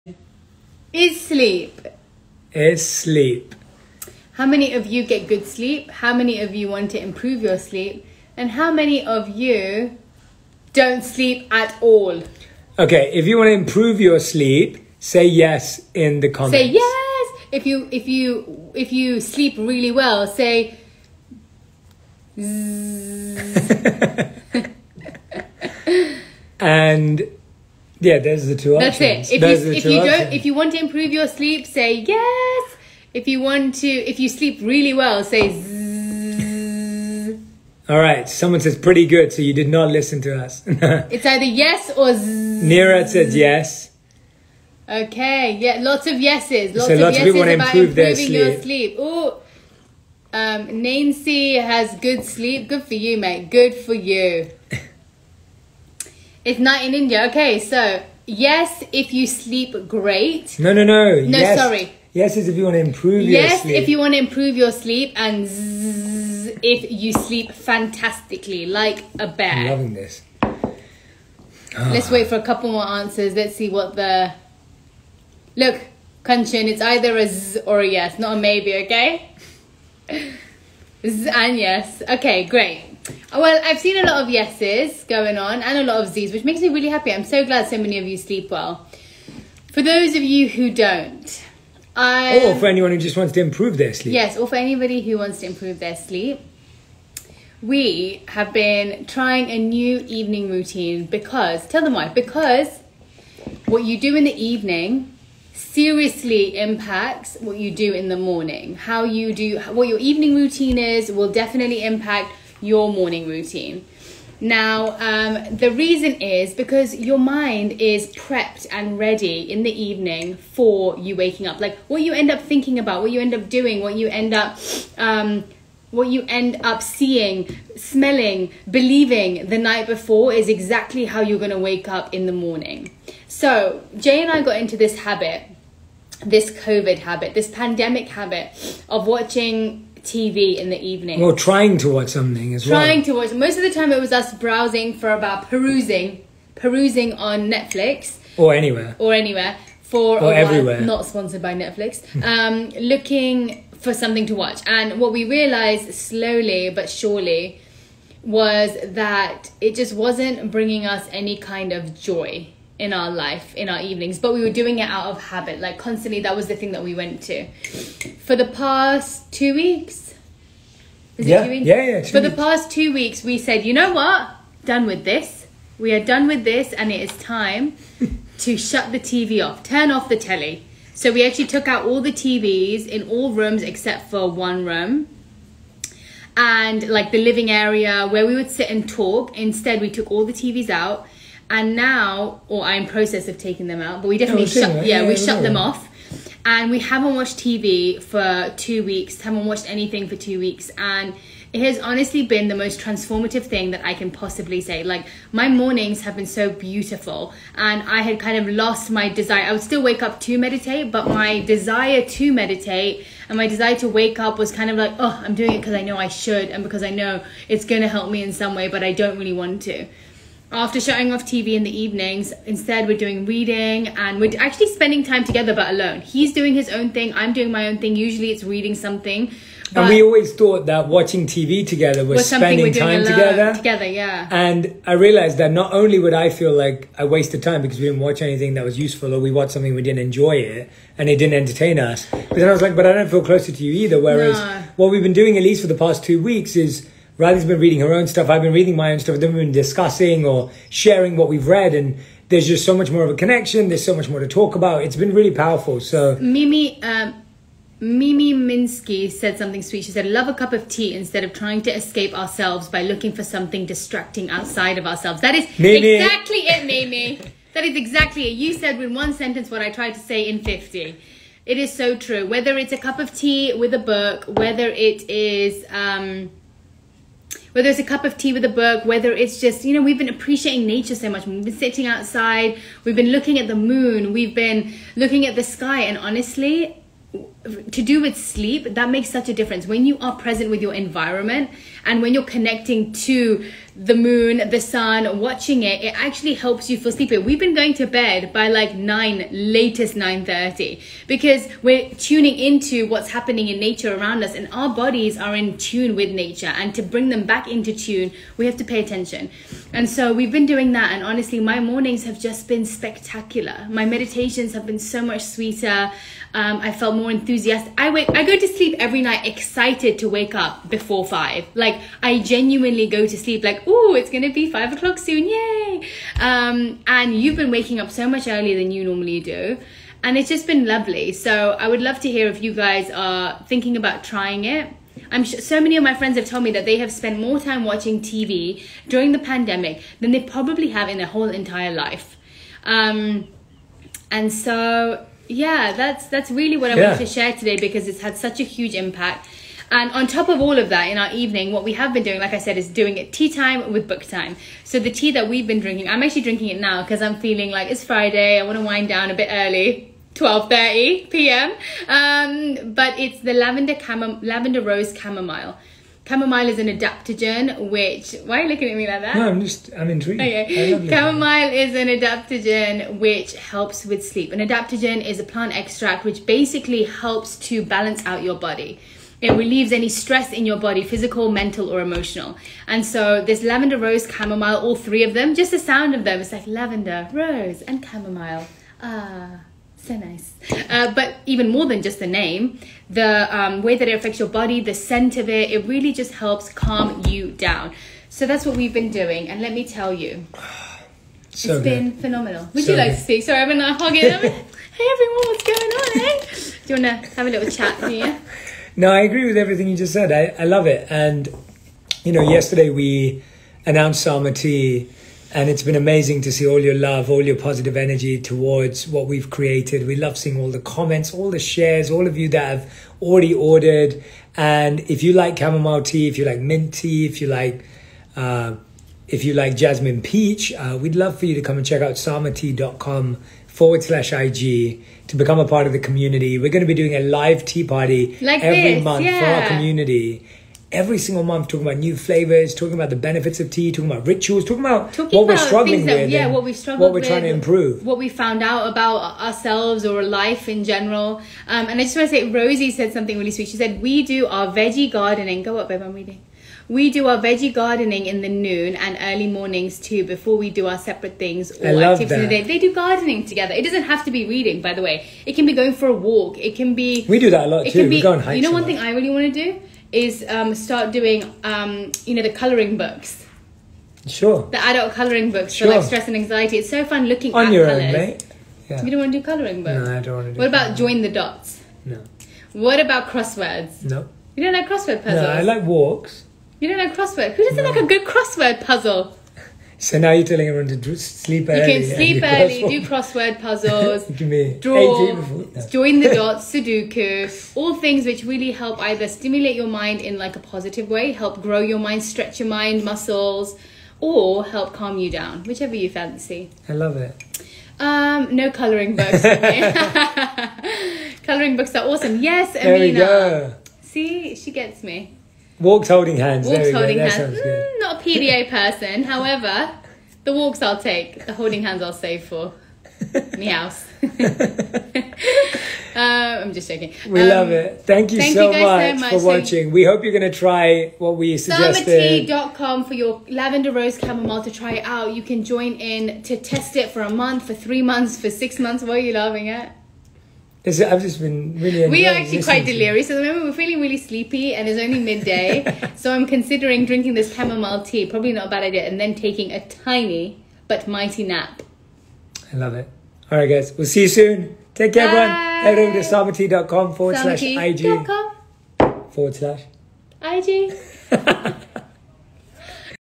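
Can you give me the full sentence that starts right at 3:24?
Like, my mornings have been so beautiful, and I had kind of lost my desire.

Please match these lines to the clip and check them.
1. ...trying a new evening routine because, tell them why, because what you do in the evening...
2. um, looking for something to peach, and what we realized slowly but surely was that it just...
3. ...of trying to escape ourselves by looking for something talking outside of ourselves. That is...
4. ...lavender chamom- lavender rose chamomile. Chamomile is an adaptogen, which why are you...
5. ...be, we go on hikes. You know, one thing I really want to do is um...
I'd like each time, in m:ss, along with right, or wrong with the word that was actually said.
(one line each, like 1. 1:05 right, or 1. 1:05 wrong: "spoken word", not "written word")
1. 1:39 right
2. 2:32 wrong: "watch", not "peach"
3. 4:21 wrong: "distracting", not "talking"
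4. 6:03 right
5. 7:47 right.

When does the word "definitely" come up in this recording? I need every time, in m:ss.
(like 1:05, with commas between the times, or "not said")
1:51, 3:14.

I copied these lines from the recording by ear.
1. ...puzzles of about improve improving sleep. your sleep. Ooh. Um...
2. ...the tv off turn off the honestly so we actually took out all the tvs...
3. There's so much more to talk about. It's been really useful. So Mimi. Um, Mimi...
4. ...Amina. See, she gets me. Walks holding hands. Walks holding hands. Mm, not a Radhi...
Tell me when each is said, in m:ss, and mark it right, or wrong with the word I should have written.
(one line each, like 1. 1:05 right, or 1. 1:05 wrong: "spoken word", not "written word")
1. 0:47 wrong: "yeses", not "puzzles"
2. 2:58 wrong: "telly", not "honestly"
3. 4:13 wrong: "powerful", not "useful"
4. 8:32 wrong: "PDA", not "Radhi".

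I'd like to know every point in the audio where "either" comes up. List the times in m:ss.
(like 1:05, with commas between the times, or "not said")
0:41, 1:16, 4:03, 8:18.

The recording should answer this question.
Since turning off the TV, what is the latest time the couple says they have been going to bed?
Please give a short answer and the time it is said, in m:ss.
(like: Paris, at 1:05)
9:30, at 4:59.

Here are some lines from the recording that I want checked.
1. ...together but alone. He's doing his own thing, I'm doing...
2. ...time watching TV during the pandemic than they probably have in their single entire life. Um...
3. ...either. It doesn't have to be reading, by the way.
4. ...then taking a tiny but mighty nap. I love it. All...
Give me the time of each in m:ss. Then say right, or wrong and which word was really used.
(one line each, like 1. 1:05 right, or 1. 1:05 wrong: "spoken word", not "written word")
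1. 3:45 right
2. 5:37 wrong: "whole", not "single"
3. 7:43 wrong: "together", not "either"
4. 9:08 right.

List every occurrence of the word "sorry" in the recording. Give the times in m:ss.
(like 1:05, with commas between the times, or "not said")
1:01, 6:43.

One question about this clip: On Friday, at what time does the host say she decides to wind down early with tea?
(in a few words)
12:30 p.m.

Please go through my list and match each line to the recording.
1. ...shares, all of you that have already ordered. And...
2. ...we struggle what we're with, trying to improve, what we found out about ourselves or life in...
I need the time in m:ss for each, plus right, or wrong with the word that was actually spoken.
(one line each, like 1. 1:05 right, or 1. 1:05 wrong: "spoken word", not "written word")
1. 7:01 right
2. 7:26 right.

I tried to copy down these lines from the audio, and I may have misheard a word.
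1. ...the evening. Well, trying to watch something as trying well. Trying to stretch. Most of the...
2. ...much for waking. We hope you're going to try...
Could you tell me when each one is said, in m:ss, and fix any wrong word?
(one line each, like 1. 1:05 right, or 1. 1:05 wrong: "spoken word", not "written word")
1. 2:20 wrong: "watch", not "stretch"
2. 8:49 wrong: "watching", not "waking".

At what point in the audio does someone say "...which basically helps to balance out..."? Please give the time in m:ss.
6:16.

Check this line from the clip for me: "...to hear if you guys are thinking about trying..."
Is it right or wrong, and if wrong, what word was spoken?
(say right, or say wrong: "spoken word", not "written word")
right.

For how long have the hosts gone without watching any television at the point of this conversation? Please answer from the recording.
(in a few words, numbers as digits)
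2 weeks.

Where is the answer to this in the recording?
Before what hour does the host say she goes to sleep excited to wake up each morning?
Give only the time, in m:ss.
5:20.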